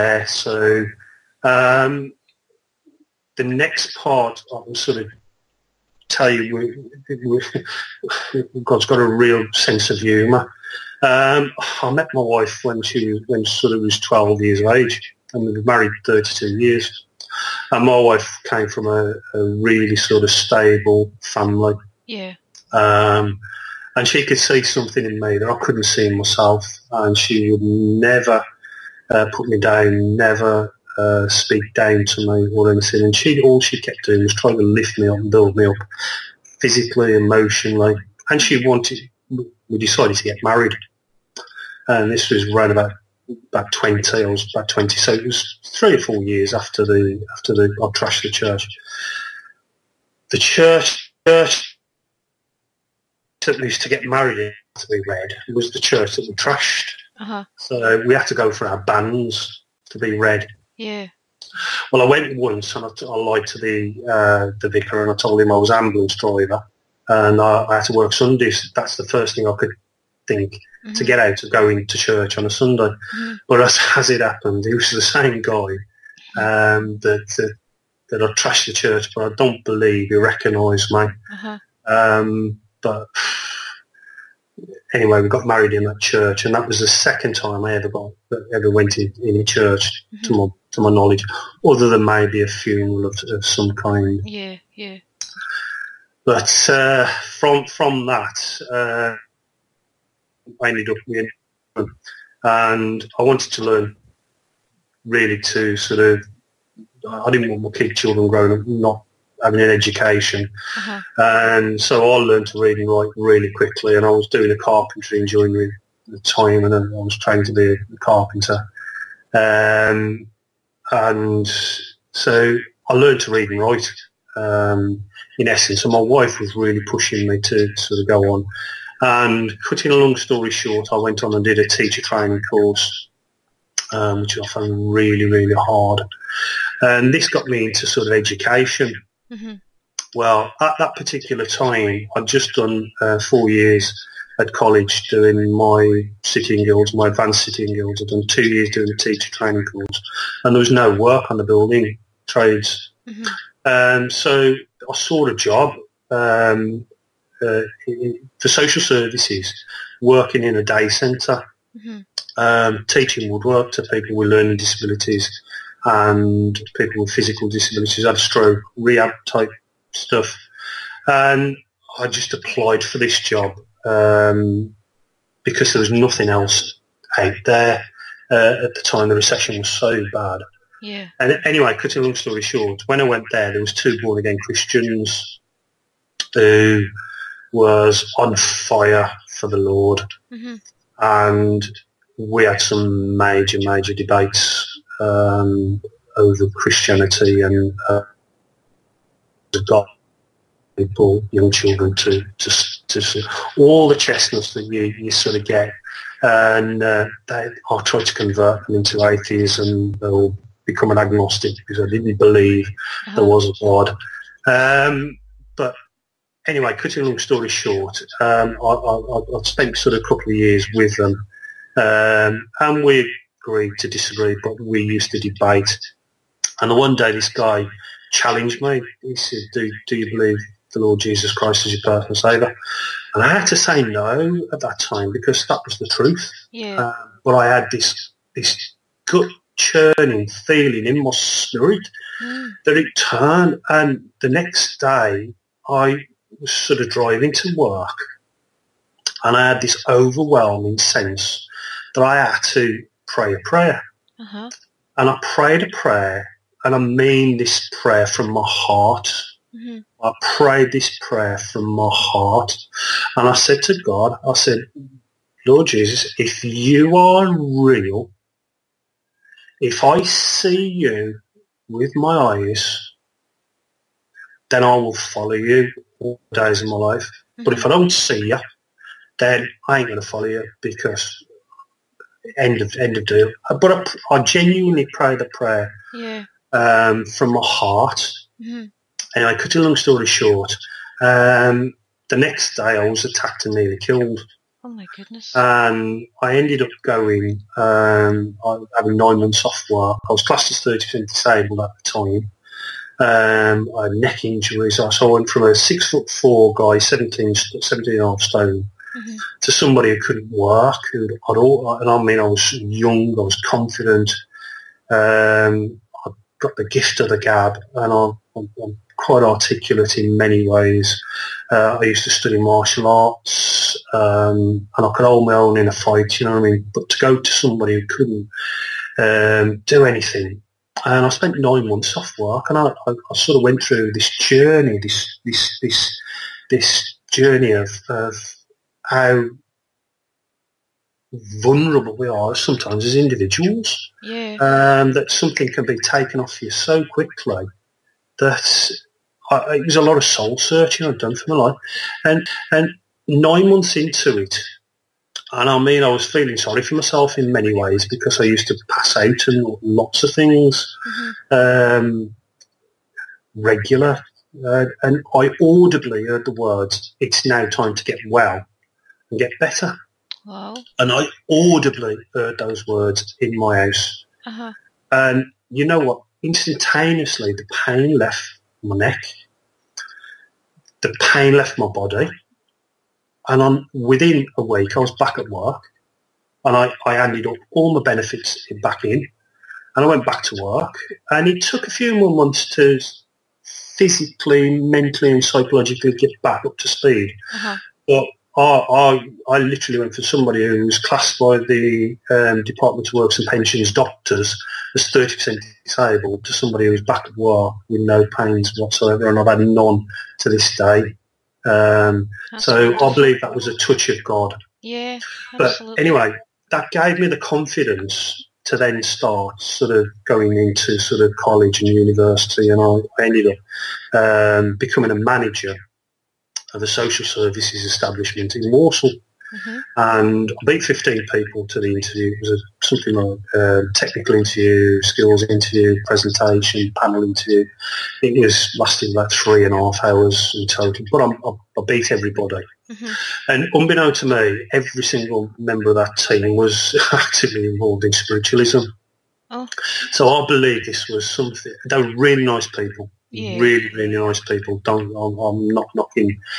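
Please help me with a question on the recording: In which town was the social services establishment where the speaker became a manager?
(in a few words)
Walsall.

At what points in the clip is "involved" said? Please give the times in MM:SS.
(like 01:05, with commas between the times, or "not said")
07:27.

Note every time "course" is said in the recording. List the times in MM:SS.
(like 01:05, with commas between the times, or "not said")
02:12, 02:29.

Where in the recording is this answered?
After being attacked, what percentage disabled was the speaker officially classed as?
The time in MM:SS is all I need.
05:00.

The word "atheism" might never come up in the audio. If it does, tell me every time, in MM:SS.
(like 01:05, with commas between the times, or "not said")
03:29.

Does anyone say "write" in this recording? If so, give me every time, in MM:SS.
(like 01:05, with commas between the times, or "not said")
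01:52, 02:03.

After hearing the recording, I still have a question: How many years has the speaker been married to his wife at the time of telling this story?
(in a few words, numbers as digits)
32.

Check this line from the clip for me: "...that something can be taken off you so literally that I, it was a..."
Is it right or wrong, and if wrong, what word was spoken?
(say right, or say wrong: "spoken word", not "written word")
wrong: "quickly", not "literally".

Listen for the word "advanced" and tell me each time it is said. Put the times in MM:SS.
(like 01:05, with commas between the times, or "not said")
02:27.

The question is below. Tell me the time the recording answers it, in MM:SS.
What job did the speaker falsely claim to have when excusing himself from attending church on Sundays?
01:05.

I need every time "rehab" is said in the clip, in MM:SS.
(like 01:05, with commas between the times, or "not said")
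02:48.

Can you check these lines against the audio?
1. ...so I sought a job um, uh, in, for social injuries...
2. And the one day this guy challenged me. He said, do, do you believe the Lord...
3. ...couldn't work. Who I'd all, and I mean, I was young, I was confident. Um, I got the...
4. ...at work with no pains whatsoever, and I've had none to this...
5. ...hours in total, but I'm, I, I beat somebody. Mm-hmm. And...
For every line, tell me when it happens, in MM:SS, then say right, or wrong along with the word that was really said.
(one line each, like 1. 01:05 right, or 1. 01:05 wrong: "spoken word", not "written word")
1. 02:34 wrong: "services", not "injuries"
2. 03:46 right
3. 05:10 right
4. 06:47 right
5. 07:19 wrong: "everybody", not "somebody".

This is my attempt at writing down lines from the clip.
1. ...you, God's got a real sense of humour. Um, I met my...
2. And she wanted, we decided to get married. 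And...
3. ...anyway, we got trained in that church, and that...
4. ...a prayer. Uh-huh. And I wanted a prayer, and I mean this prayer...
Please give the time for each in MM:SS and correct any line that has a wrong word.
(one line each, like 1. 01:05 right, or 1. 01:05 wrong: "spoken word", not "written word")
1. 00:06 right
2. 00:38 right
3. 01:24 wrong: "married", not "trained"
4. 04:13 wrong: "prayed", not "wanted".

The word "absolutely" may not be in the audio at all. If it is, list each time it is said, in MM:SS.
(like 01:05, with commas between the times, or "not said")
06:55.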